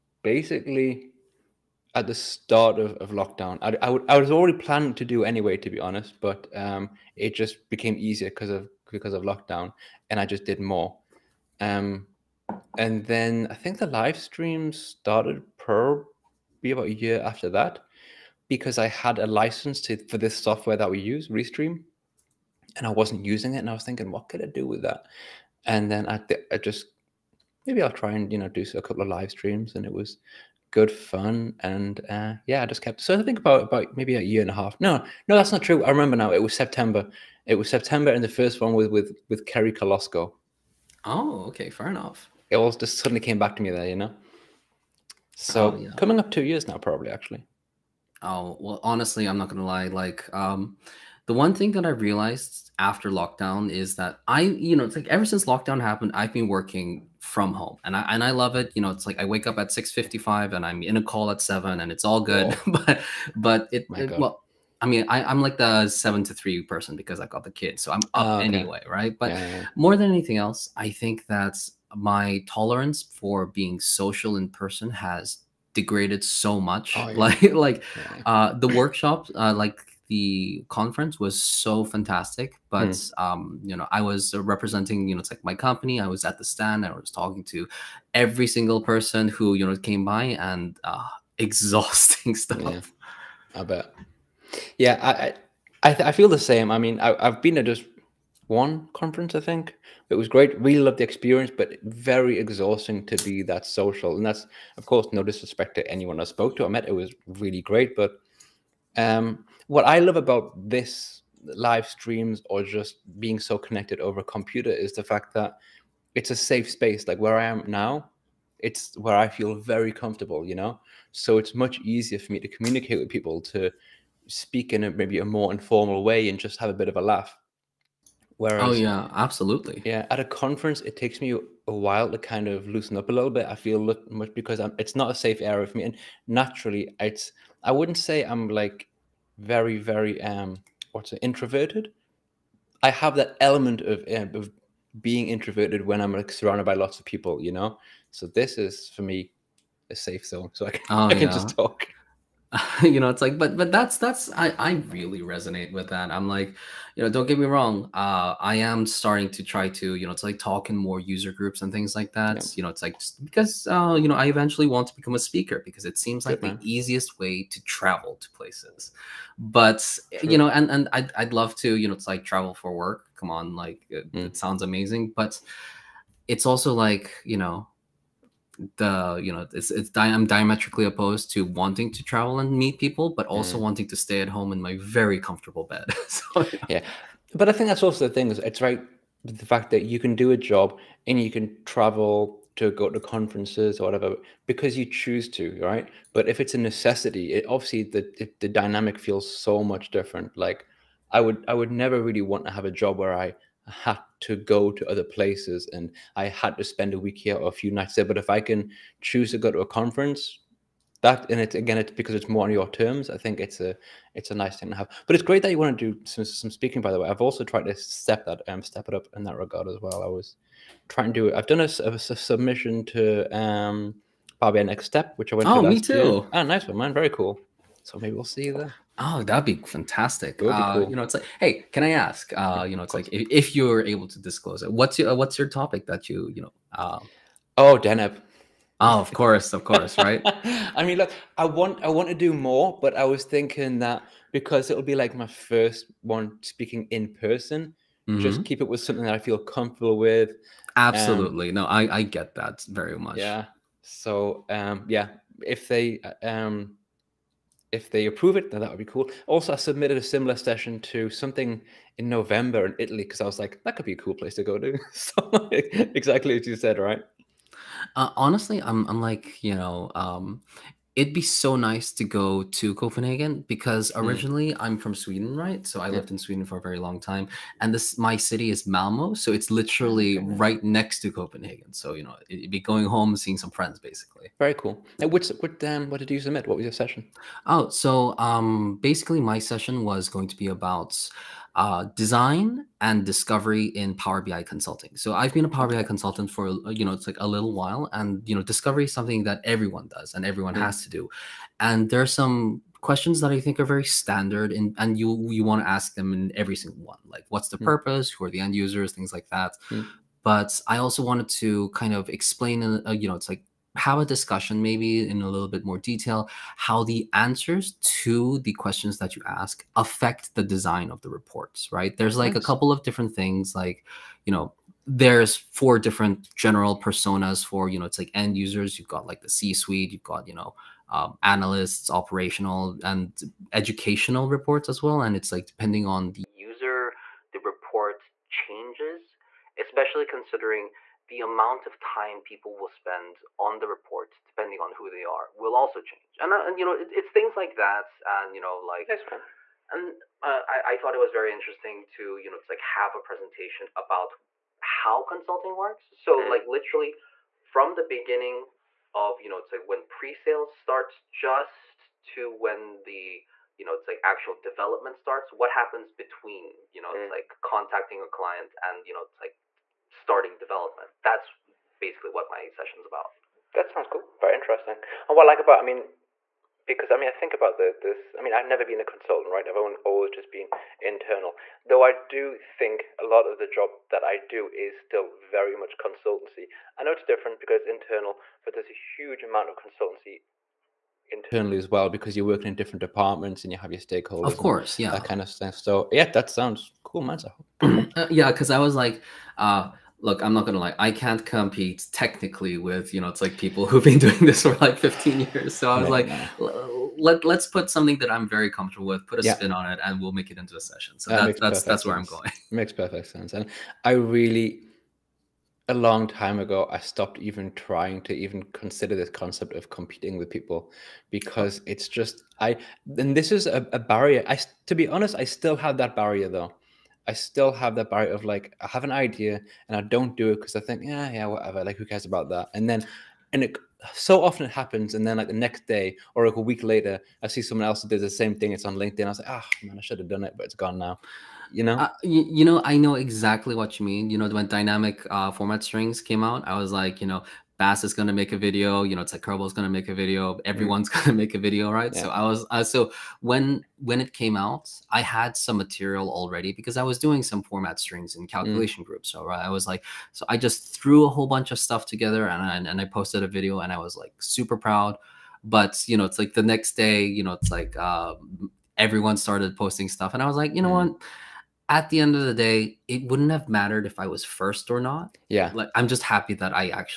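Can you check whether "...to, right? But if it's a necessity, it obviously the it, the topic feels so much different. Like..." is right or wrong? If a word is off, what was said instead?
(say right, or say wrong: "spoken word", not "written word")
wrong: "dynamic", not "topic".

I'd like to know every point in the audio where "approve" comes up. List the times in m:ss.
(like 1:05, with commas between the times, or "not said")
4:18.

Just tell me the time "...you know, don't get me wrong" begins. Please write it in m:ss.
2:36.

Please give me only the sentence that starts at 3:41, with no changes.
I've done a, a, a submission to um a Next Step, which I went.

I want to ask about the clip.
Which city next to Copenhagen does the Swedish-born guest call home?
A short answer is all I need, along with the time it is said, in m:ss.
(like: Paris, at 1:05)
Malmo, at 4:38.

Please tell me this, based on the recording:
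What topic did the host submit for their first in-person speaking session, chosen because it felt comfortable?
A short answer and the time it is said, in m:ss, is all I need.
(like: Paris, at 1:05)
Deneb, at 3:57.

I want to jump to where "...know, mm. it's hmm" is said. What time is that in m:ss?
6:06.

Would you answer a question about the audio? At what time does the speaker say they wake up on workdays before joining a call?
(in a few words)
6:55.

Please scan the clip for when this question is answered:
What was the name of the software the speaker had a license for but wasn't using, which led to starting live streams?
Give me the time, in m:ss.
0:21.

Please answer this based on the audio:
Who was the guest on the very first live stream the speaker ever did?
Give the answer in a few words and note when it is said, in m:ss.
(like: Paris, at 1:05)
Kerry Kolosko, at 0:39.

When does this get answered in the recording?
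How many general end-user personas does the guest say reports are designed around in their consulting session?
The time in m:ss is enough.
5:25.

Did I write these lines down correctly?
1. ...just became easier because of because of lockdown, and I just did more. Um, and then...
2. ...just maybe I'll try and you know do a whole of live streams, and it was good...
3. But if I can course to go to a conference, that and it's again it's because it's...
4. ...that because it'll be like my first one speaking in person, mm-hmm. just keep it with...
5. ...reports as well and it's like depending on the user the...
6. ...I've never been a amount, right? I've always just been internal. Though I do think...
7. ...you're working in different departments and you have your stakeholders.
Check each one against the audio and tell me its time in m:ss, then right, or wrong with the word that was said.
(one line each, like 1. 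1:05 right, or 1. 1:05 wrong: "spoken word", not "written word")
1. 0:07 right
2. 0:26 wrong: "couple", not "whole"
3. 3:28 wrong: "choose", not "course"
4. 4:03 right
5. 5:34 right
6. 6:18 wrong: "consultant", not "amount"
7. 6:32 right.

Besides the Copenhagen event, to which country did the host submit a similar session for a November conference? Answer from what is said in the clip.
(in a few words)
Italy.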